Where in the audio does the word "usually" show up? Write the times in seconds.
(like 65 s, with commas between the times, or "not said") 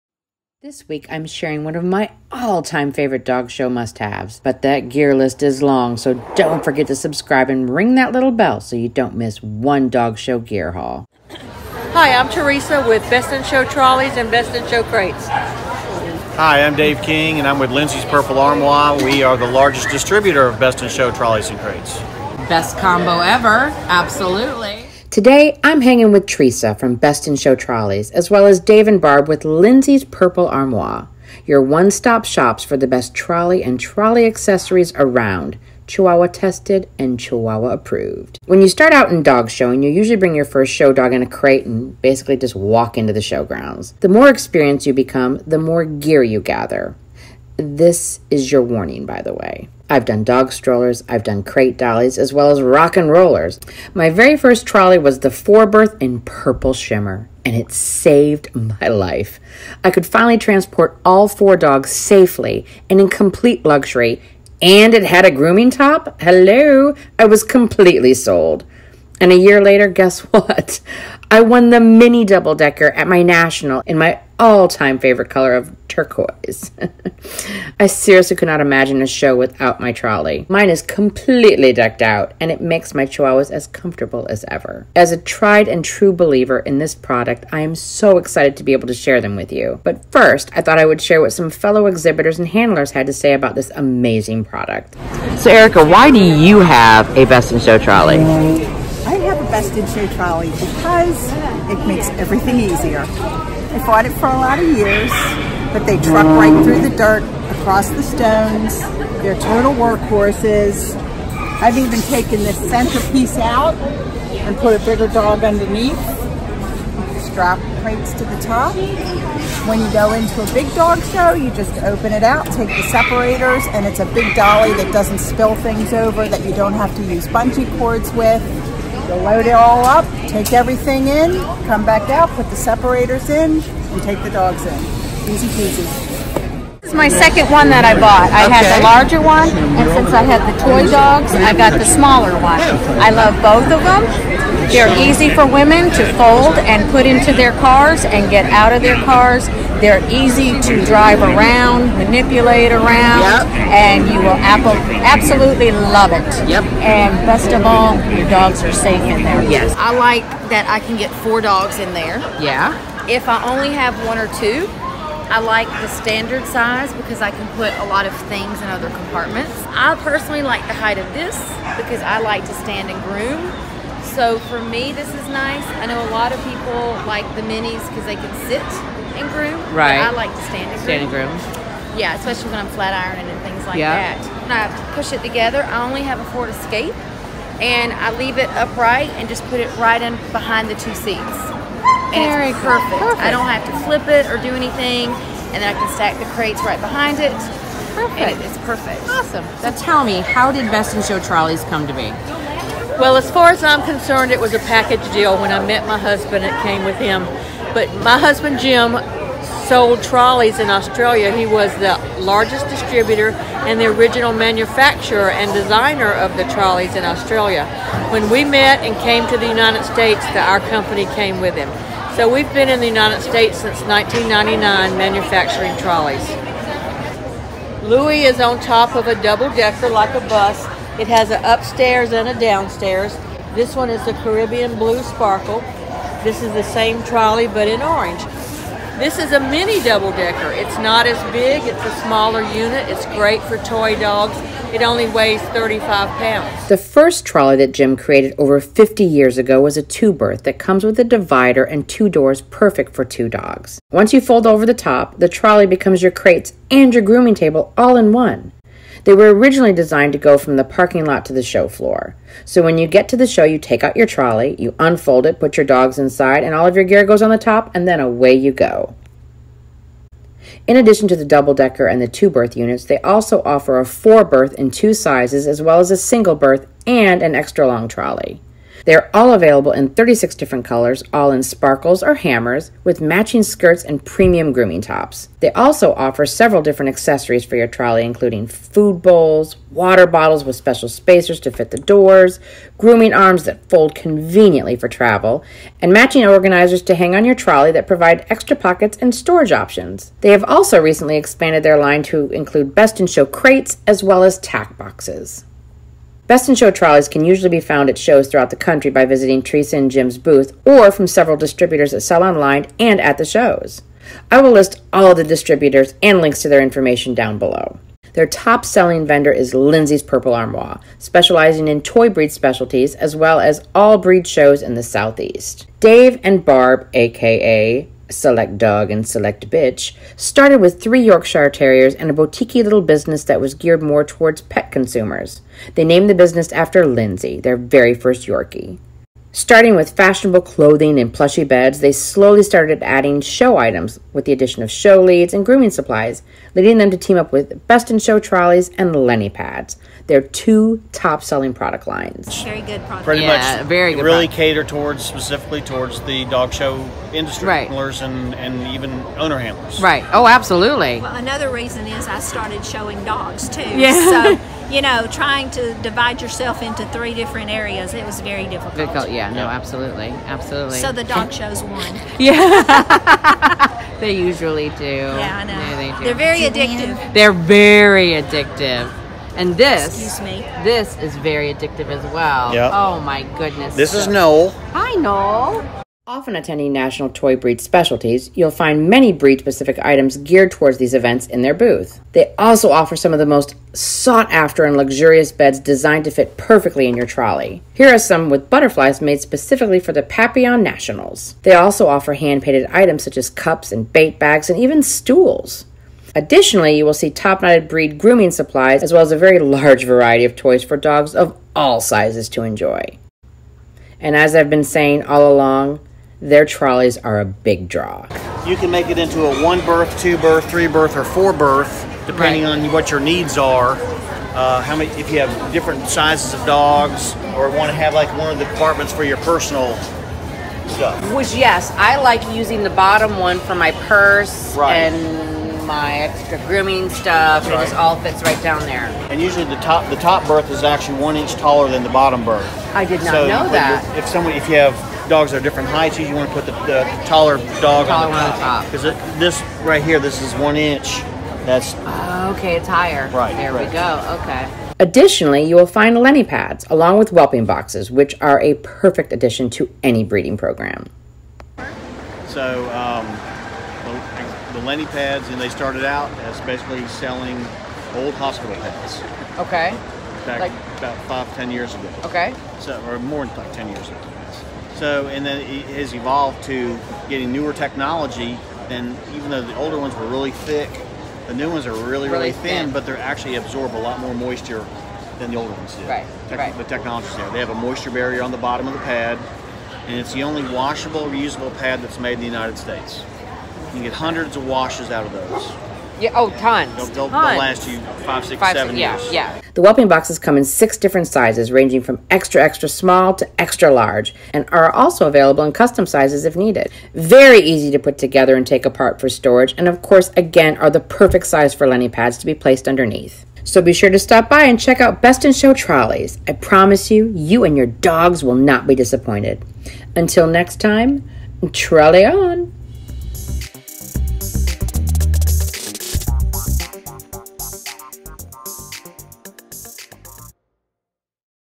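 39 s, 307 s, 374 s, 439 s.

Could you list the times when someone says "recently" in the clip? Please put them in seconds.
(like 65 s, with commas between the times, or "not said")
300 s.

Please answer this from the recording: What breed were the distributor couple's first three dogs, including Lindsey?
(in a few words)
Yorkshire Terriers.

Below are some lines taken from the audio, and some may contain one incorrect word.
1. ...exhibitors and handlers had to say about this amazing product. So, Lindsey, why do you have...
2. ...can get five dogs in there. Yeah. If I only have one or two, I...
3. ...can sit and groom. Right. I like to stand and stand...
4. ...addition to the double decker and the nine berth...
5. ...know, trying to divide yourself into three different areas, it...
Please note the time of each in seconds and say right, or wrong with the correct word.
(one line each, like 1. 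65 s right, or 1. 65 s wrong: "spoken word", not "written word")
1. 91 s wrong: "Erica", not "Lindsey"
2. 160 s wrong: "four", not "five"
3. 178 s right
4. 270 s wrong: "two", not "nine"
5. 364 s right.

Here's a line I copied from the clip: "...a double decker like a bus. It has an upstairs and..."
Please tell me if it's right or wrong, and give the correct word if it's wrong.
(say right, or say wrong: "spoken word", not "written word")
right.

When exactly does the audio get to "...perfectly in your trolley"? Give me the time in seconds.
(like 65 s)
396 s.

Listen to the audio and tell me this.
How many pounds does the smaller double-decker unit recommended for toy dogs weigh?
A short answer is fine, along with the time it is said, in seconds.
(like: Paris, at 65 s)
35 pounds, at 245 s.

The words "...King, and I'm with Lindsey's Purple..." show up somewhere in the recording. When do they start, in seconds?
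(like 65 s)
17 s.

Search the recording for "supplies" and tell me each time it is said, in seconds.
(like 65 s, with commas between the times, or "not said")
345 s, 408 s.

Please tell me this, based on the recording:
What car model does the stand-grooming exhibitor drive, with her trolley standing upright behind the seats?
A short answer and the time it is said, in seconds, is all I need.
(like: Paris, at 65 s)
Ford Escape, at 186 s.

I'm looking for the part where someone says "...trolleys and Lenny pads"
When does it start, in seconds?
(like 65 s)
348 s.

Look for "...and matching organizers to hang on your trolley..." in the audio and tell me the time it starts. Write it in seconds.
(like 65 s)
295 s.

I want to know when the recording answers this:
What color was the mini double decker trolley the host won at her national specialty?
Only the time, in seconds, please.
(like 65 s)
75 s.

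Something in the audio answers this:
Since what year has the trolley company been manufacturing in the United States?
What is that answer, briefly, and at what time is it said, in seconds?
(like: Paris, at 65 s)
1999, at 223 s.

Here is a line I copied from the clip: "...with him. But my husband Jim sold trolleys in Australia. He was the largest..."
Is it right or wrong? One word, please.
right.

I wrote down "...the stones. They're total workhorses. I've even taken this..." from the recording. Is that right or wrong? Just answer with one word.
right.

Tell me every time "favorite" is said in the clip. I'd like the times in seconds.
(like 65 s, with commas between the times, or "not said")
2 s, 74 s.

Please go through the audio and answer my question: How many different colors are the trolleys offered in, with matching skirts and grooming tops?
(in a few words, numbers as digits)
36.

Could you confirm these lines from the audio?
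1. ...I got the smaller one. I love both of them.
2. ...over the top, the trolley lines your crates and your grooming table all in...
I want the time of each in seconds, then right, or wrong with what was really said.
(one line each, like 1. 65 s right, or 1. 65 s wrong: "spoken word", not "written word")
1. 141 s right
2. 254 s wrong: "becomes", not "lines".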